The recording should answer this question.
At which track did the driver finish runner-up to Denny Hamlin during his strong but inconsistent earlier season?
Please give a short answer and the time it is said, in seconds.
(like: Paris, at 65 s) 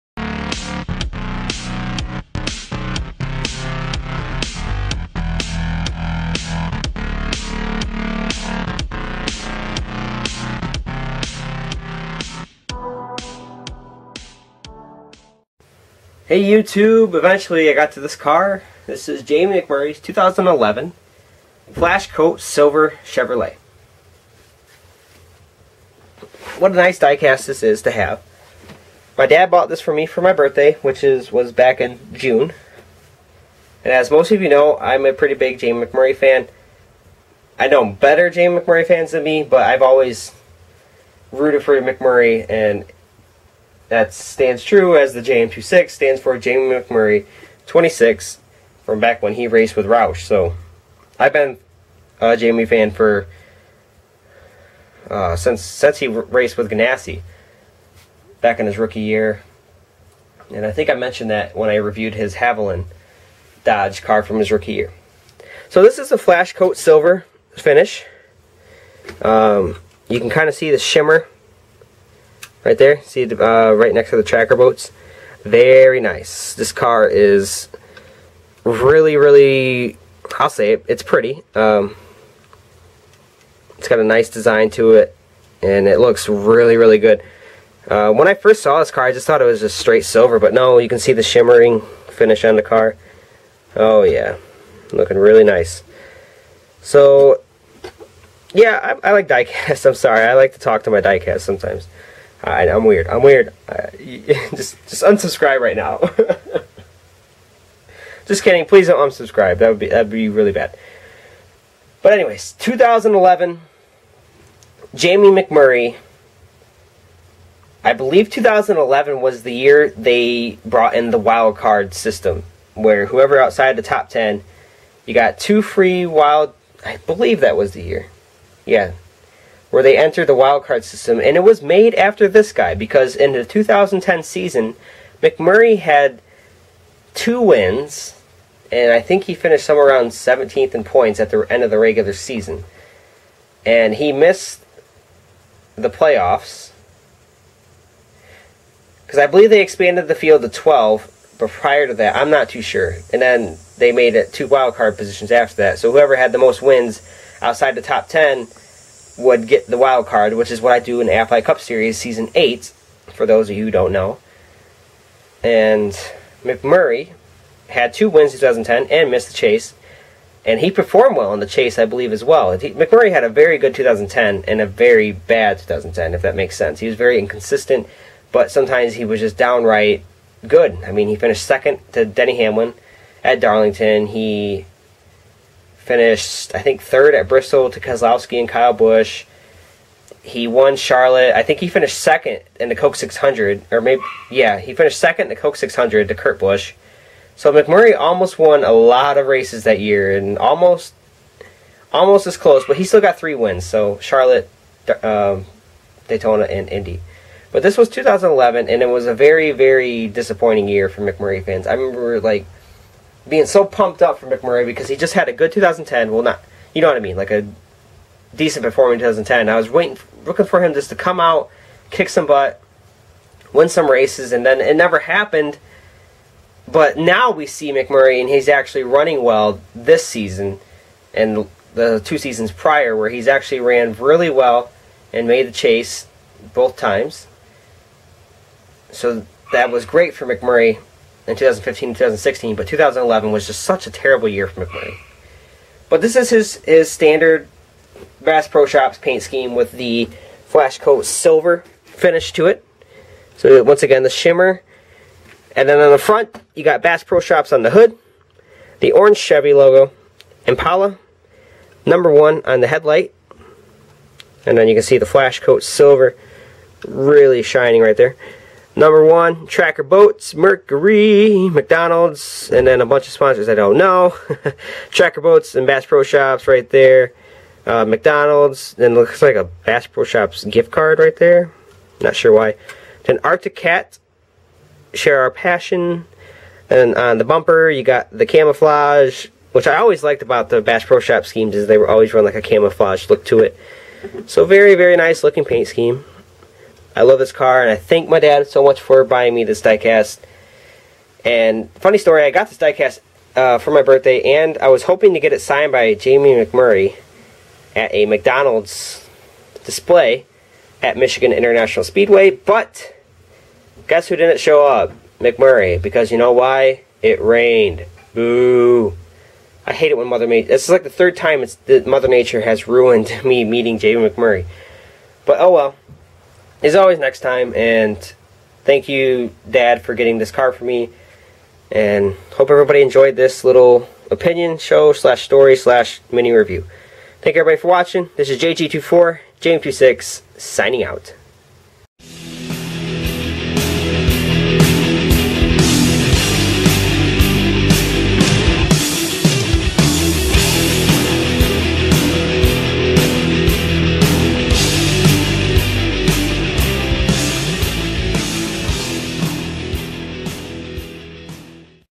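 Darlington, at 183 s.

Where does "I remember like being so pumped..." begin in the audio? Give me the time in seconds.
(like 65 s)
211 s.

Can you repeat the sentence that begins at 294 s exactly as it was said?
So very, very nice looking paint scheme.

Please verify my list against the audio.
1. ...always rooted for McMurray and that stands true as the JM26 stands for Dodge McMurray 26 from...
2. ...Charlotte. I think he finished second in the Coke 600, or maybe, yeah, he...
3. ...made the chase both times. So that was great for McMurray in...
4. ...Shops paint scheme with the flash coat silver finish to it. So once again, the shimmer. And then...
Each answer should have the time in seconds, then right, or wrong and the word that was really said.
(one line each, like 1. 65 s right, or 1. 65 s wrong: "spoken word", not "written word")
1. 39 s wrong: "Jamie", not "Dodge"
2. 190 s right
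3. 235 s right
4. 248 s right.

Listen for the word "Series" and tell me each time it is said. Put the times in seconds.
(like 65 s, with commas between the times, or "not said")
161 s.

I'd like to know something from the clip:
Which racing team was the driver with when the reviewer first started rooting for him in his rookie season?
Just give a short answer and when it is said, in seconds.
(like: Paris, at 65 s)
Ganassi, at 56 s.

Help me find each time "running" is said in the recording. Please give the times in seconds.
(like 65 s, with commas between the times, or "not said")
228 s.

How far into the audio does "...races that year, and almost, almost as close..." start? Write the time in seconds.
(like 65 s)
199 s.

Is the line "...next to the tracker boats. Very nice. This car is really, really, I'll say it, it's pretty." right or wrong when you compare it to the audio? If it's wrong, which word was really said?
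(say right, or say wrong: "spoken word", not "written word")
right.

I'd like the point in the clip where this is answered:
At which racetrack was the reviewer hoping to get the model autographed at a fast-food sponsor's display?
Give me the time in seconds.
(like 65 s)
310 s.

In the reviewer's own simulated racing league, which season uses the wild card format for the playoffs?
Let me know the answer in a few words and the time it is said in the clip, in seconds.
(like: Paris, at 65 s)
Season 8, at 161 s.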